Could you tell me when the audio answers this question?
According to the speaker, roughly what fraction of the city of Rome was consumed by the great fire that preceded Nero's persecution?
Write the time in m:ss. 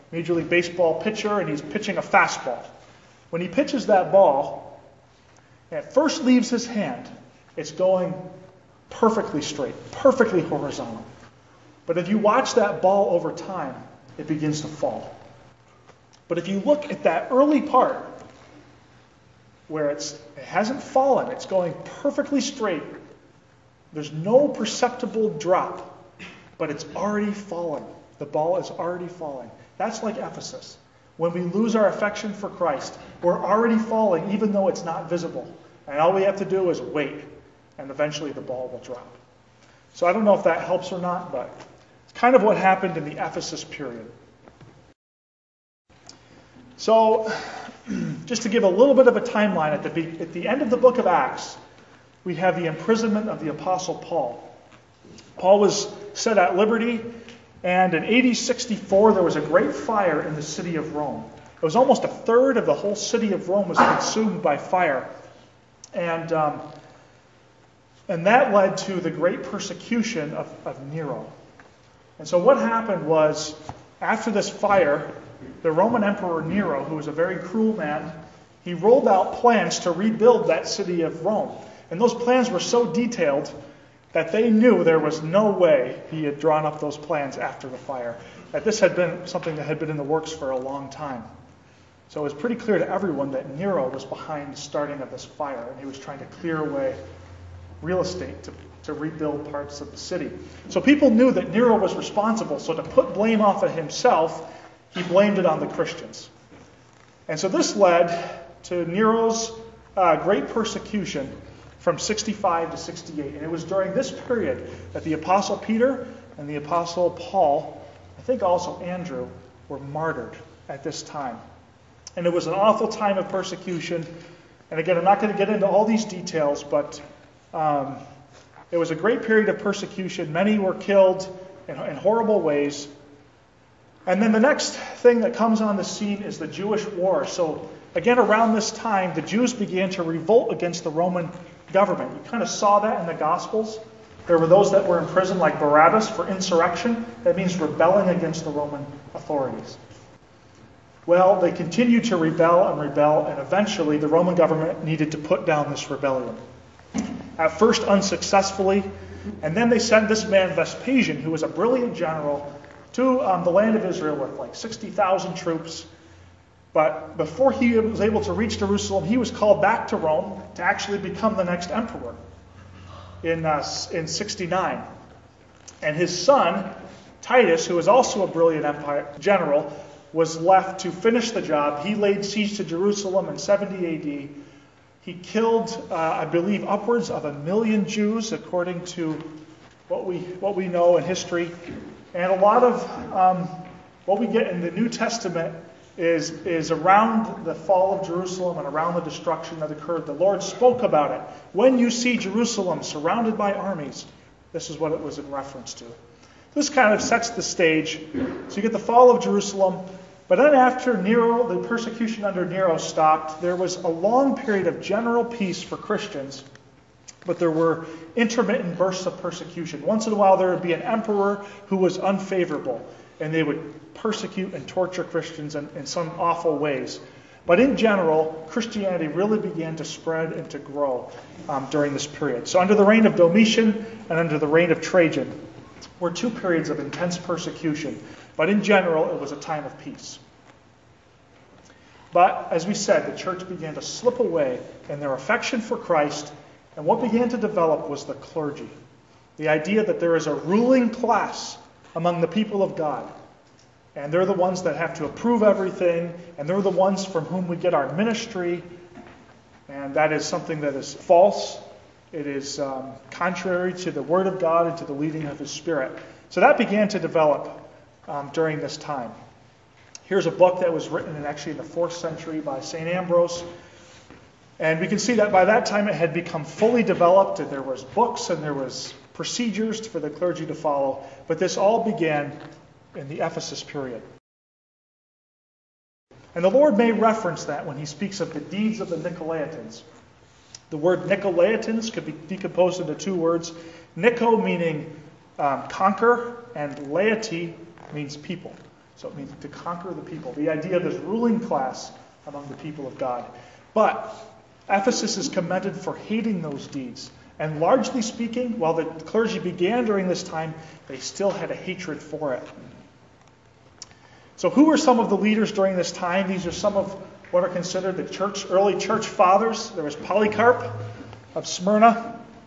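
1:02.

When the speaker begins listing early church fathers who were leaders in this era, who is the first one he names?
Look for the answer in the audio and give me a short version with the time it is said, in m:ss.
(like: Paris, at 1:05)
Polycarp of Smyrna, at 5:19.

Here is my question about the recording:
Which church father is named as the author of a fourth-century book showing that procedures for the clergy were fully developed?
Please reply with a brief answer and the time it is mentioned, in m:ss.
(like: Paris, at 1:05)
St. Ambrose, at 4:32.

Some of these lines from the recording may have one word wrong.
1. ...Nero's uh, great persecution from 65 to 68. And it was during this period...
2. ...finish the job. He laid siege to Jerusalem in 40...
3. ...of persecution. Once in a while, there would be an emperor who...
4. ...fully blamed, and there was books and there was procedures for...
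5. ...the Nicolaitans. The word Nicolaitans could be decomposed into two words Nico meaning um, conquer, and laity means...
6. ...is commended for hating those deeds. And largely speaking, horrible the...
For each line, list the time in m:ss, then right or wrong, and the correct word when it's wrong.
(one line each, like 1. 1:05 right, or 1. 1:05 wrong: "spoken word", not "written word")
1. 1:48 right
2. 3:00 wrong: "70", not "40"
3. 3:39 right
4. 4:36 wrong: "developed", not "blamed"
5. 4:48 right
6. 5:05 wrong: "while", not "horrible".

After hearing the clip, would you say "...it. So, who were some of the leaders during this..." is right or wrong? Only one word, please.
right.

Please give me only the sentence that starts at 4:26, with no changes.
So that began to develop um, during this time.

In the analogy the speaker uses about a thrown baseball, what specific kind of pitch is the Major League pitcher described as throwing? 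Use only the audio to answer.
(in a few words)
fastball.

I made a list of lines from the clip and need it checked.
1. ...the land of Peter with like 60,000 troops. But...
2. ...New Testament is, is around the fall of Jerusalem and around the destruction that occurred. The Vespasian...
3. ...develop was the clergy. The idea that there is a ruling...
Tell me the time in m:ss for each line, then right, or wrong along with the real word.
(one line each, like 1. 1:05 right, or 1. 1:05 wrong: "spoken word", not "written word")
1. 2:43 wrong: "Israel", not "Peter"
2. 3:14 wrong: "Lord", not "Vespasian"
3. 4:07 right.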